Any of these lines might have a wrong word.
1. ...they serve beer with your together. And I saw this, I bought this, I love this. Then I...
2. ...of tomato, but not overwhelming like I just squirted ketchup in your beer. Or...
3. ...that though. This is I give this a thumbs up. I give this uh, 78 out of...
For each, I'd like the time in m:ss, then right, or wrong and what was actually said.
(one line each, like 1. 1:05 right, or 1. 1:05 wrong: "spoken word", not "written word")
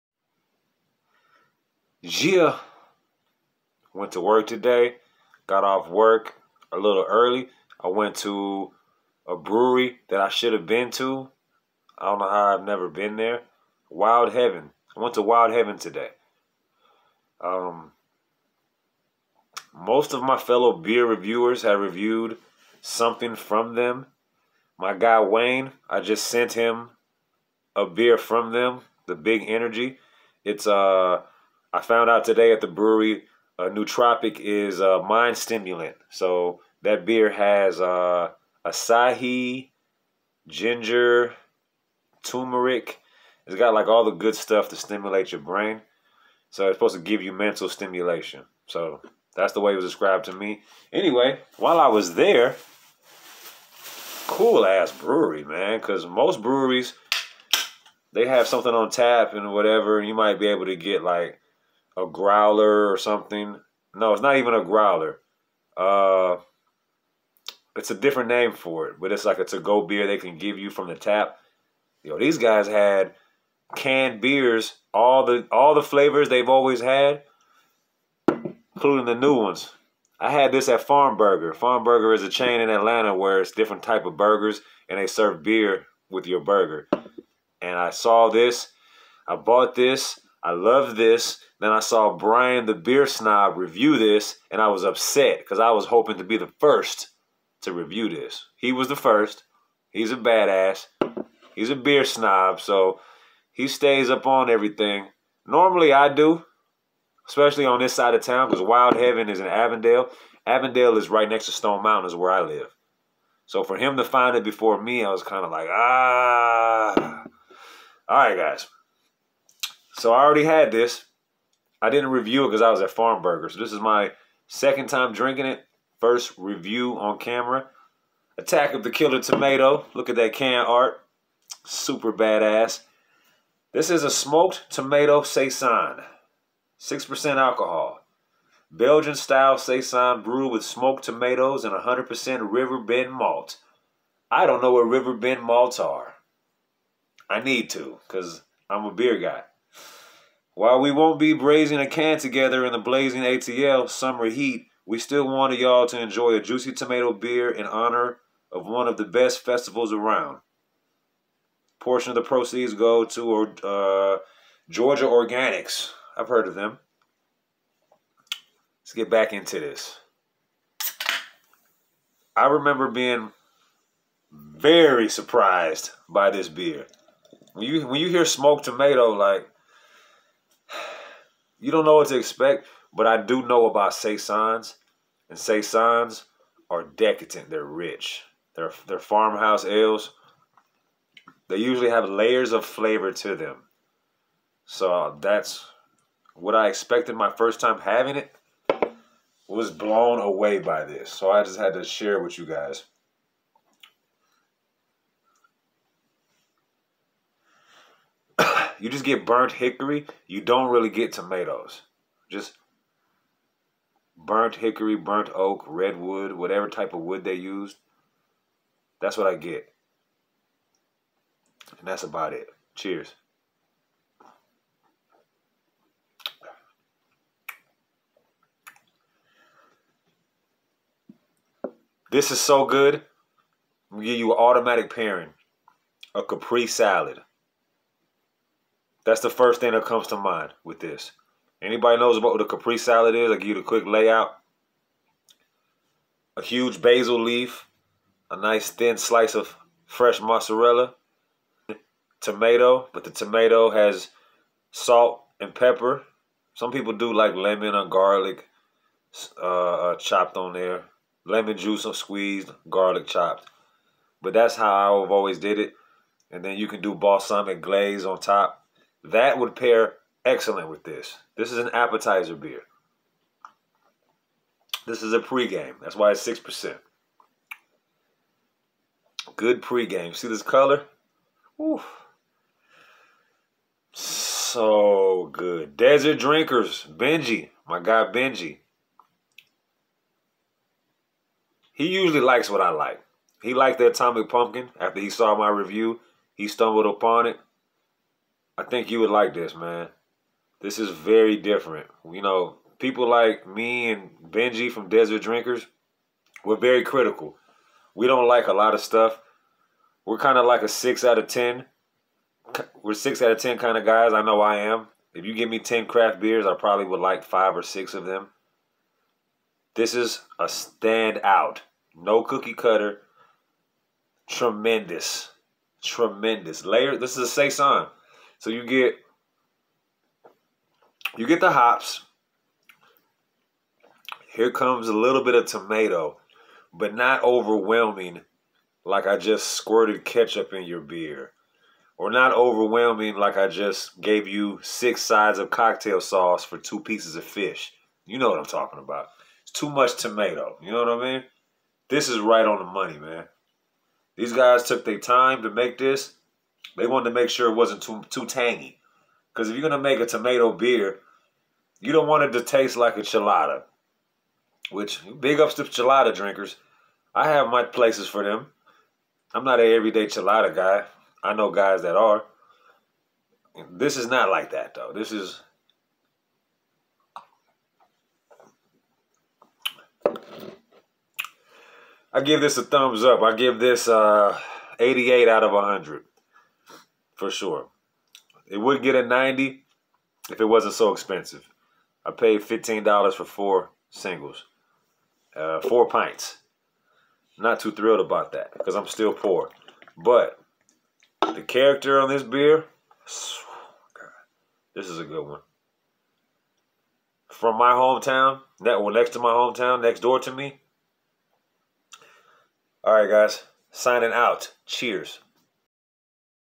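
1. 1:24 wrong: "burger", not "together"
2. 5:35 right
3. 6:14 wrong: "88", not "78".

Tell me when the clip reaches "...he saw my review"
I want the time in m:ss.
4:54.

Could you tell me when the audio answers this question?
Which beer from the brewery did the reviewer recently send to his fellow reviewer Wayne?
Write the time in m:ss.
0:29.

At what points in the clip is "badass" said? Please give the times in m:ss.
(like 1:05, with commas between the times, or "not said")
1:40, 2:12.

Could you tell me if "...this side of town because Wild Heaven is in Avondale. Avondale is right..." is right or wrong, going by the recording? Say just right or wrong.
right.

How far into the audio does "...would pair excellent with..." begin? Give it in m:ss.
4:29.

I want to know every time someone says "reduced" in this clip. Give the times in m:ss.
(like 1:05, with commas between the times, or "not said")
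not said.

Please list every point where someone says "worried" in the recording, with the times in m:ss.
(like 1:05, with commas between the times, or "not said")
not said.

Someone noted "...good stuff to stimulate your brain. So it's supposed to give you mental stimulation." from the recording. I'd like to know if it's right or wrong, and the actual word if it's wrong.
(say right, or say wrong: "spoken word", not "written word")
right.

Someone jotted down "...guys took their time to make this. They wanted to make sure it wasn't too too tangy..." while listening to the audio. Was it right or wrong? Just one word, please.
right.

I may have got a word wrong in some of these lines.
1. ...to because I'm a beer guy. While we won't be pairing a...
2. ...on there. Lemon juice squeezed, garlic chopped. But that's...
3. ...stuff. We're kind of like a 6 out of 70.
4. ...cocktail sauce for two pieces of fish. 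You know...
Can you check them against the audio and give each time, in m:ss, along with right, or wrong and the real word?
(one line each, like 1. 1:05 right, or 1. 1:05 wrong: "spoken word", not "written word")
1. 2:27 wrong: "braising", not "pairing"
2. 4:20 right
3. 5:08 wrong: "10", not "70"
4. 5:45 right.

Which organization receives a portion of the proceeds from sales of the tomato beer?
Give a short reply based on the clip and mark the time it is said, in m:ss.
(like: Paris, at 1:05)
Georgia Organics, at 2:44.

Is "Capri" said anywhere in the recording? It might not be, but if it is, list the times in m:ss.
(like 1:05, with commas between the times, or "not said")
3:56, 4:02.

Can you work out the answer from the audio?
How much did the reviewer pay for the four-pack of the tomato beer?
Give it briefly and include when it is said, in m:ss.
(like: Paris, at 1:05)
$15, at 6:32.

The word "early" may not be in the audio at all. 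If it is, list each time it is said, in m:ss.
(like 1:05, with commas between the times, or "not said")
0:07.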